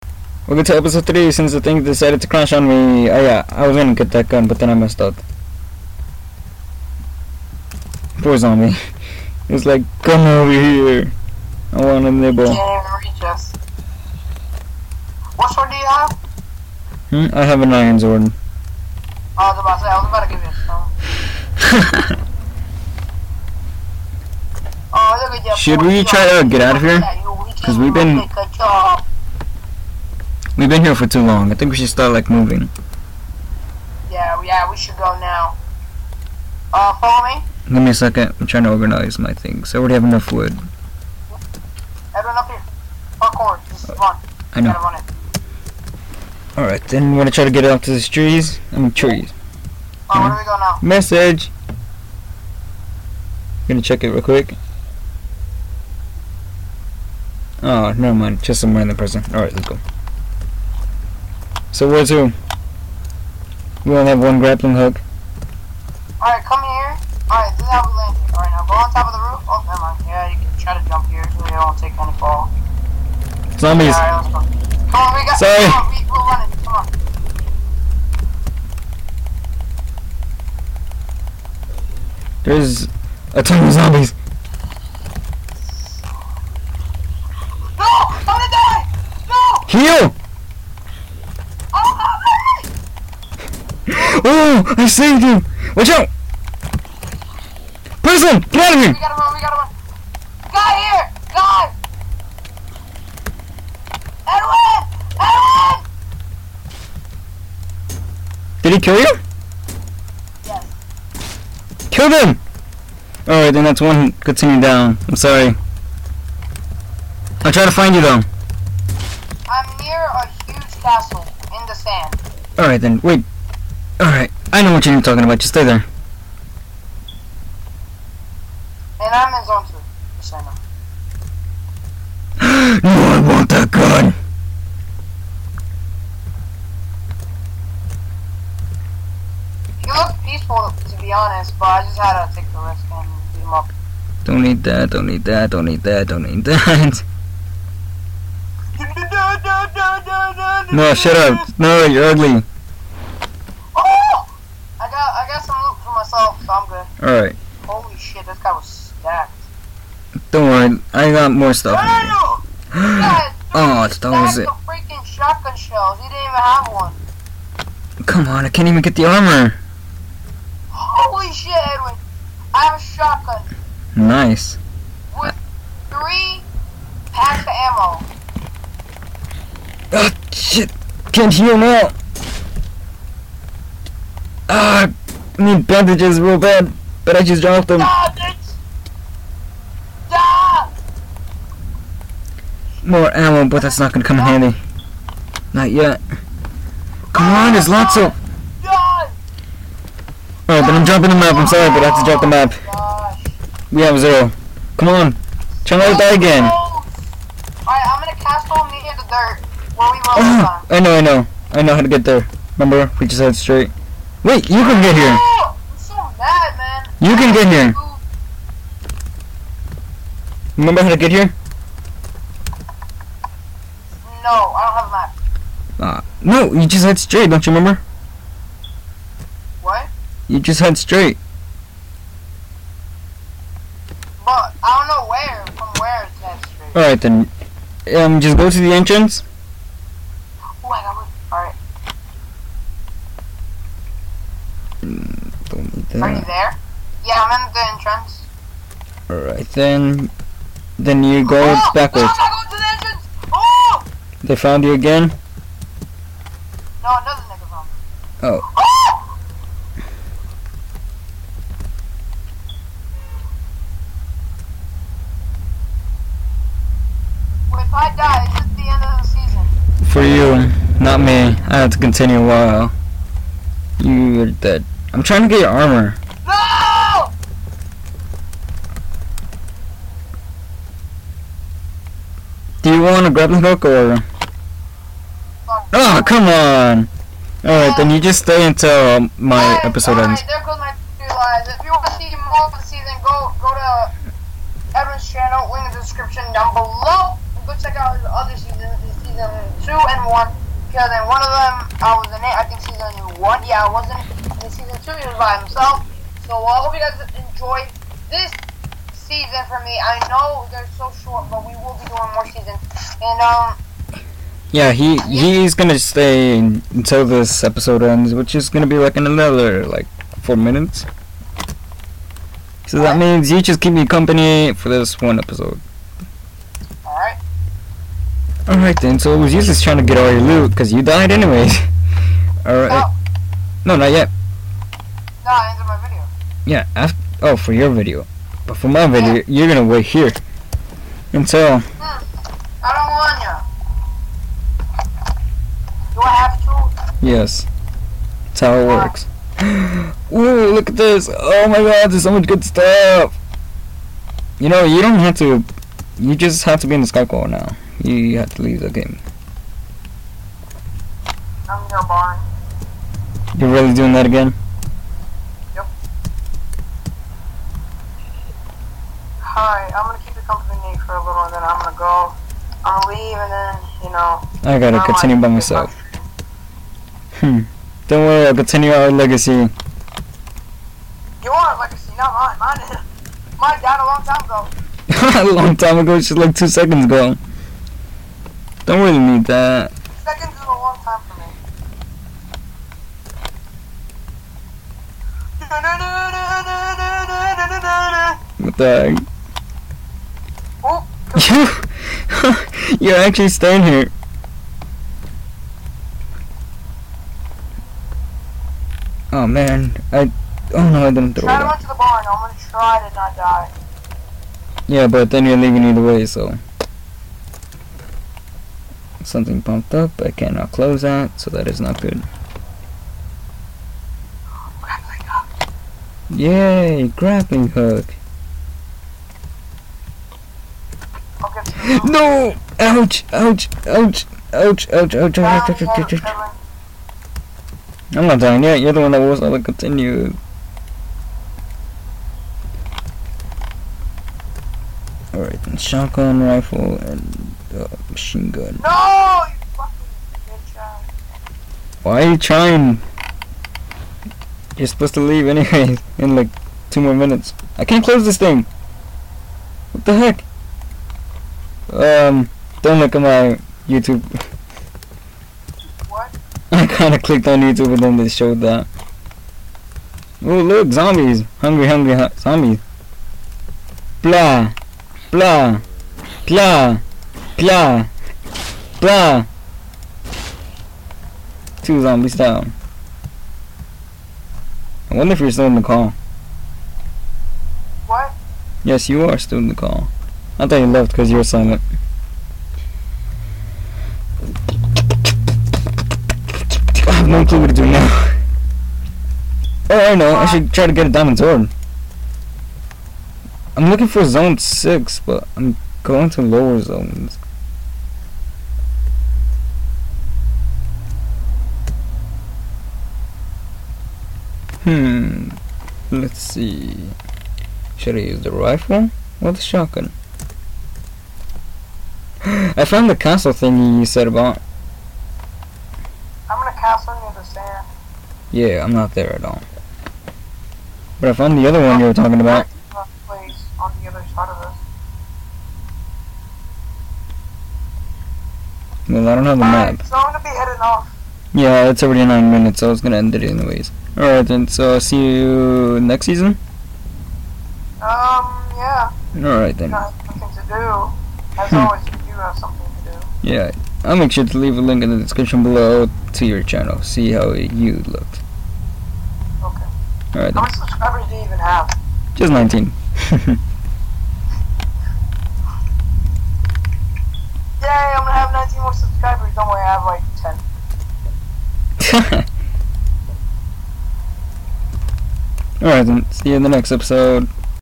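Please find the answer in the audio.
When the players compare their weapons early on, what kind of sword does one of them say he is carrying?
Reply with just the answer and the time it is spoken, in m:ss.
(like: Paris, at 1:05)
iron sword, at 0:17.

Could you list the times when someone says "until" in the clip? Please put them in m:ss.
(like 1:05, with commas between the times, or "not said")
4:48, 5:16, 5:41.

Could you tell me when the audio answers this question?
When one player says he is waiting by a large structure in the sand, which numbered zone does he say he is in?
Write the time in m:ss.
2:09.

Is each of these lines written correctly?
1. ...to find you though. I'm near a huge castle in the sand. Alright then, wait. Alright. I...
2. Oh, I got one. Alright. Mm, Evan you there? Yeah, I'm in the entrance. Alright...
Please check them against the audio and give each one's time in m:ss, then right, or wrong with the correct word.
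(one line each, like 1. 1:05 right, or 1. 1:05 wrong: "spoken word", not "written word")
1. 1:57 right
2. 4:00 wrong: "Are", not "Evan".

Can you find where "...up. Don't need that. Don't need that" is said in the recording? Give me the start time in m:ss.
2:23.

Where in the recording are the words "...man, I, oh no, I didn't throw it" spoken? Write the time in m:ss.
6:49.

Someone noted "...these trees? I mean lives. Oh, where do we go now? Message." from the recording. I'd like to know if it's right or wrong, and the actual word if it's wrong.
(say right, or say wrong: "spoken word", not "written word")
wrong: "trees", not "lives".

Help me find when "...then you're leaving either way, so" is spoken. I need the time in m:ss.
6:55.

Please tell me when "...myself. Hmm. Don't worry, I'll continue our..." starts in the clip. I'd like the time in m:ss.
6:15.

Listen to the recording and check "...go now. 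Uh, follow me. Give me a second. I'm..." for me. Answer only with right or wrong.
right.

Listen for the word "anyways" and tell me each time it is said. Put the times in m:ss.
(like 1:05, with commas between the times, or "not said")
5:31, 7:35, 9:03.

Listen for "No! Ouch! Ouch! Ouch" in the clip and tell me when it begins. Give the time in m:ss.
7:11.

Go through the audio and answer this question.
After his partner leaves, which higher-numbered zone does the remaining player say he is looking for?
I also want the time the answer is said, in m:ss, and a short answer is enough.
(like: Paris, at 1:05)
zone 6, at 8:24.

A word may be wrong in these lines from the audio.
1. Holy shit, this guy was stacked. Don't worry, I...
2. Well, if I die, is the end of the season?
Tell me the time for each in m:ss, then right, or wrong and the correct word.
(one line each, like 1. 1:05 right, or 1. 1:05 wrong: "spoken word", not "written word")
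1. 2:37 right
2. 4:27 right.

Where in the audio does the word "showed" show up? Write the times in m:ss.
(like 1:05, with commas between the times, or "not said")
7:48.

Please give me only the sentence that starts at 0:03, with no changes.
Oh yeah, I was gonna get that gun, but then I messed up.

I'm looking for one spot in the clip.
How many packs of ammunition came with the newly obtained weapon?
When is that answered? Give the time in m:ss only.
2:55.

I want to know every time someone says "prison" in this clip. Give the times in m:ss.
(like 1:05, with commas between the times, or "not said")
0:58, 1:38.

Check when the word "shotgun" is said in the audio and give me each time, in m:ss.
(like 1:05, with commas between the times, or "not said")
2:45, 2:52, 7:25, 8:39.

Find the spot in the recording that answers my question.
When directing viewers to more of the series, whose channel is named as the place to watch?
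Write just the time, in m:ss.
4:54.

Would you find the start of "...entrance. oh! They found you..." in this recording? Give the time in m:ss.
4:12.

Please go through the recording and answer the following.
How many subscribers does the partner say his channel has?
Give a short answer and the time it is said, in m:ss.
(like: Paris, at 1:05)
19, at 9:22.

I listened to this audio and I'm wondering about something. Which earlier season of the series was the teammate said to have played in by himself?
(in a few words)
season 2.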